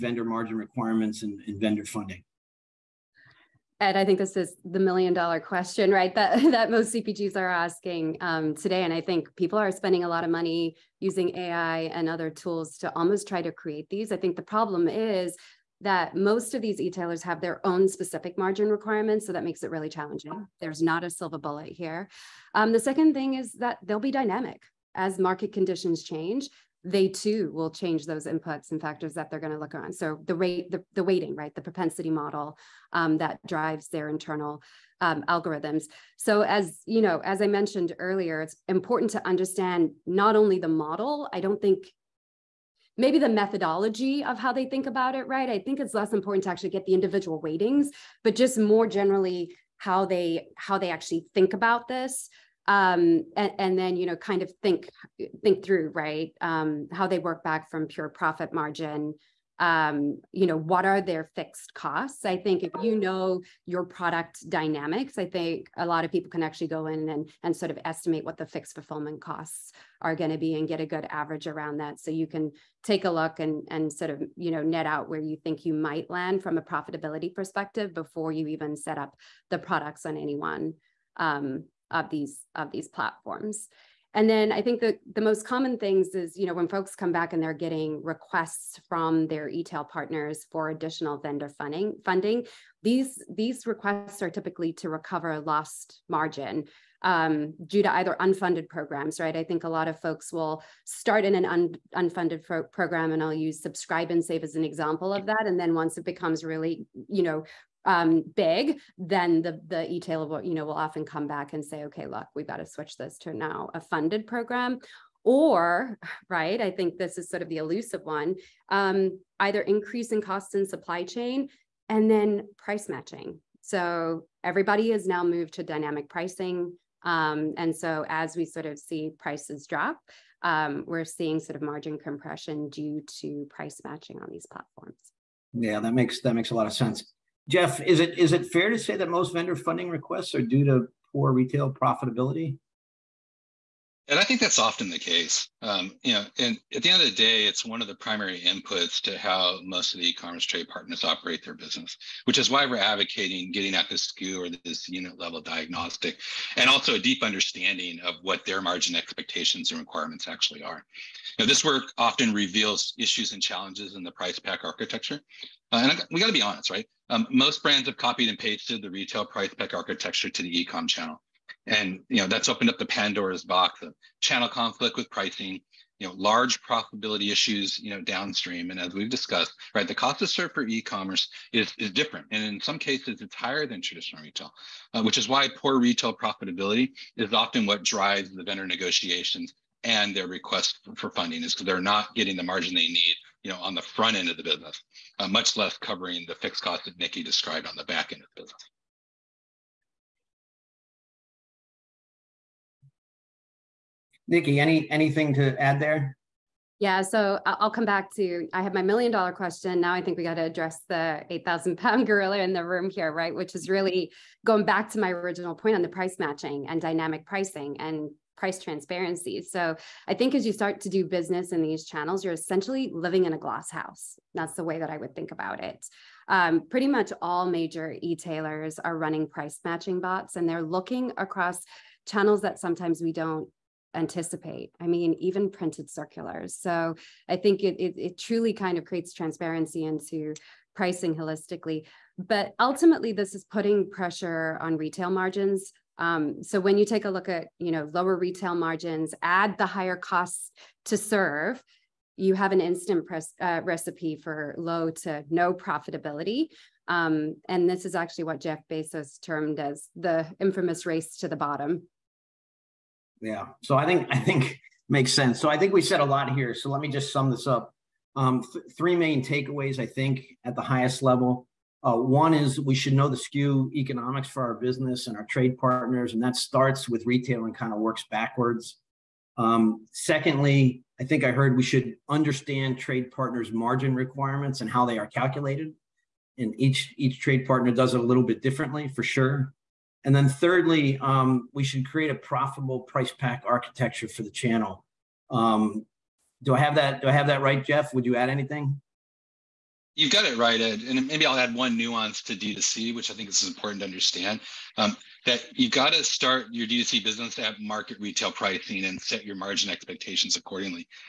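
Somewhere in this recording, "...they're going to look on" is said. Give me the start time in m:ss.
0:29.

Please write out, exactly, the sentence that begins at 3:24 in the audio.
Nikki, any anything to add there?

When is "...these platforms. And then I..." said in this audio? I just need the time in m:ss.
1:22.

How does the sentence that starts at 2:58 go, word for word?
And as we've discussed, right, the cost to serve for e-commerce is, is different.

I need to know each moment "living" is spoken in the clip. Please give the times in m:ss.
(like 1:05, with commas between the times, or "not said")
3:42.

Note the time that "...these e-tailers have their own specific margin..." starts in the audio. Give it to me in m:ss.
0:16.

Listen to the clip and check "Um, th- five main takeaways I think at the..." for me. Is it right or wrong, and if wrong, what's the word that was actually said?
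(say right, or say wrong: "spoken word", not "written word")
wrong: "three", not "five".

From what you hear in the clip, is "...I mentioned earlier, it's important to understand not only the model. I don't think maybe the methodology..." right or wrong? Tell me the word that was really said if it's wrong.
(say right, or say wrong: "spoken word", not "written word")
right.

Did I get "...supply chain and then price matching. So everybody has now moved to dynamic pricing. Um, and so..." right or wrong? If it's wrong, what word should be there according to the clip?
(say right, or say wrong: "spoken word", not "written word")
right.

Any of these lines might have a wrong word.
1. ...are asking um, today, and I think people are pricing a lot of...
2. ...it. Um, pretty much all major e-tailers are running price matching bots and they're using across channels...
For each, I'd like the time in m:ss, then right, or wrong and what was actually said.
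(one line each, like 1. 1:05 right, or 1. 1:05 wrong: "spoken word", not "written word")
1. 0:07 wrong: "spending", not "pricing"
2. 3:45 wrong: "looking", not "using".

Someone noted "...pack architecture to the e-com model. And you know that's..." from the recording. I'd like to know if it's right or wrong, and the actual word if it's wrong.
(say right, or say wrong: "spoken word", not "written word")
wrong: "channel", not "model".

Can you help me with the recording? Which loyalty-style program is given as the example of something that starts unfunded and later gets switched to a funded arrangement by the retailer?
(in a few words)
Subscribe and Save.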